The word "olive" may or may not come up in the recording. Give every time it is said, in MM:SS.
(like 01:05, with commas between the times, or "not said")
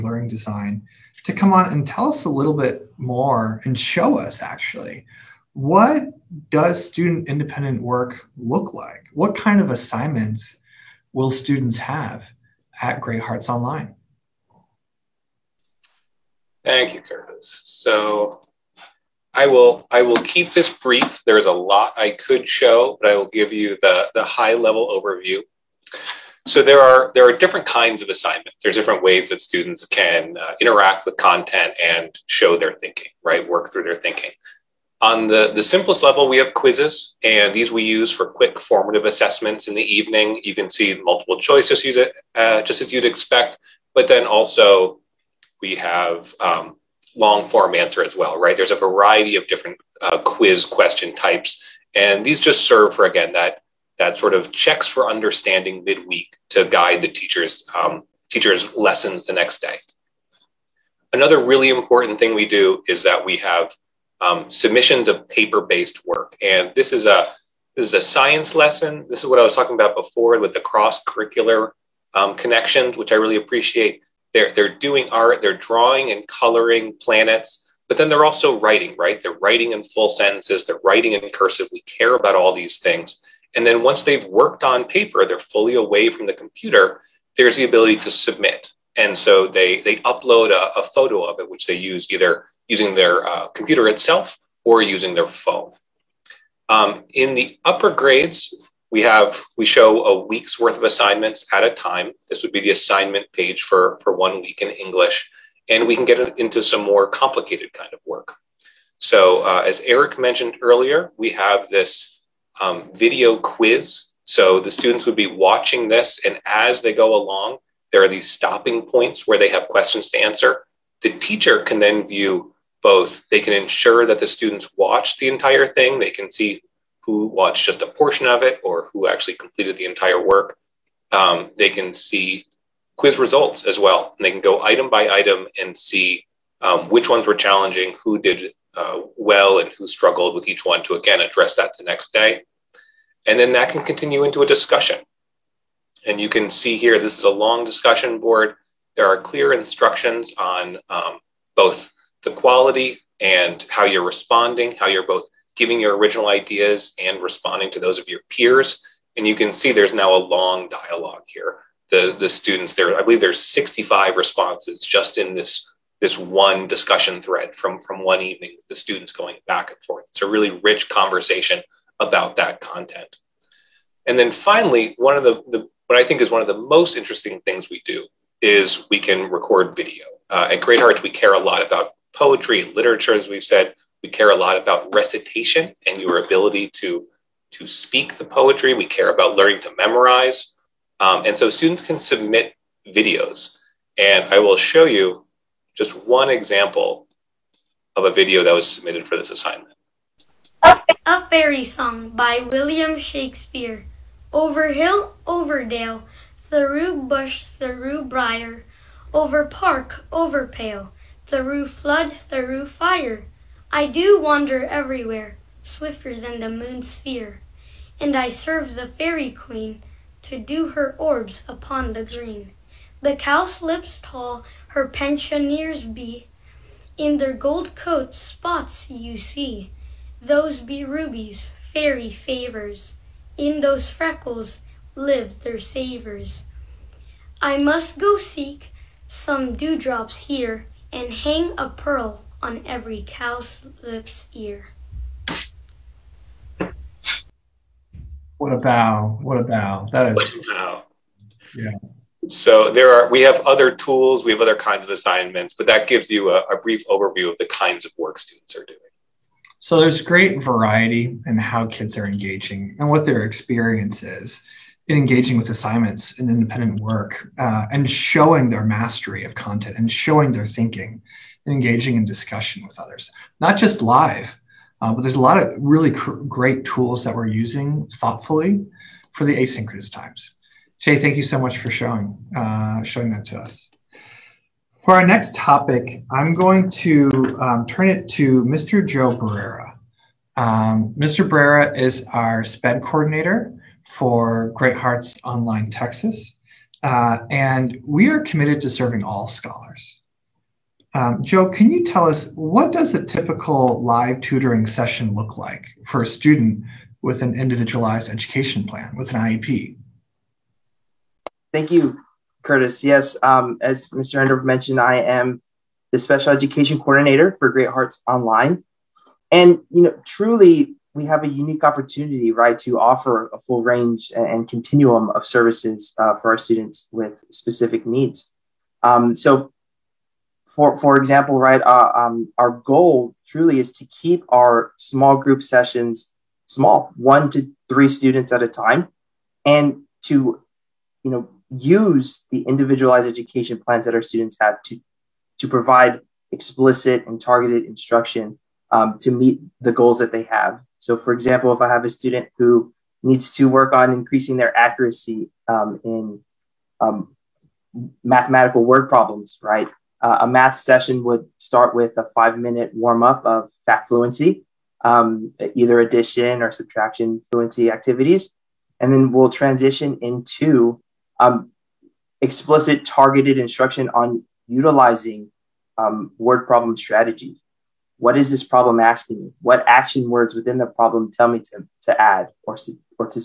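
not said.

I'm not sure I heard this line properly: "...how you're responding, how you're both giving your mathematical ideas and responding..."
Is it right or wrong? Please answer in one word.
wrong.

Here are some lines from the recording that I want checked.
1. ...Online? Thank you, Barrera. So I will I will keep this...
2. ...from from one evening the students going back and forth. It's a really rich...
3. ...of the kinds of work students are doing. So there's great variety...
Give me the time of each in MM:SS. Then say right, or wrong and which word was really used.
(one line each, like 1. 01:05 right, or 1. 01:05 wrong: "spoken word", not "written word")
1. 00:13 wrong: "Curtis", not "Barrera"
2. 02:47 right
3. 04:17 right.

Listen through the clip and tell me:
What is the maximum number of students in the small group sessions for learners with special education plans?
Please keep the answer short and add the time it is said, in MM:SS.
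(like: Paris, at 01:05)
3, at 05:37.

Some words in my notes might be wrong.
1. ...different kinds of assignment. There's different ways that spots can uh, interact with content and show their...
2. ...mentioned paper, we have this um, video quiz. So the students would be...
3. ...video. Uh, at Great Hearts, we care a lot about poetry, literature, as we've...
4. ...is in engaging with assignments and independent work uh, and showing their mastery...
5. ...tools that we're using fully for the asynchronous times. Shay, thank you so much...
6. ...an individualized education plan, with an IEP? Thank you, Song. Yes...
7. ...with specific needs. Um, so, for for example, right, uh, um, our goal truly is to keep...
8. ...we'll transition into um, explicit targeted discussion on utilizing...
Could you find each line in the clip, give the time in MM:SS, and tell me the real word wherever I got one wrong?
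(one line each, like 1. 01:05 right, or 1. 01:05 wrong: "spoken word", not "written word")
1. 00:27 wrong: "students", not "spots"
2. 01:50 wrong: "earlier", not "paper"
3. 02:59 right
4. 04:24 right
5. 04:36 wrong: "thoughtfully", not "fully"
6. 05:07 wrong: "Curtis", not "Song"
7. 05:26 right
8. 06:09 wrong: "instruction", not "discussion".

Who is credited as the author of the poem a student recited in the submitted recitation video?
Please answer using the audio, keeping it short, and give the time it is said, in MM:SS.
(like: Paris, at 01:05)
William Shakespeare, at 03:22.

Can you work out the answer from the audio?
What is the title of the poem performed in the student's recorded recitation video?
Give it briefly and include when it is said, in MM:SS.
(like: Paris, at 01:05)
A Fairy Song, at 03:21.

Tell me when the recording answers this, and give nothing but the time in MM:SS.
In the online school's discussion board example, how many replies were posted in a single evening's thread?
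02:43.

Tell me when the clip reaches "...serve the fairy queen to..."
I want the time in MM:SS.
03:38.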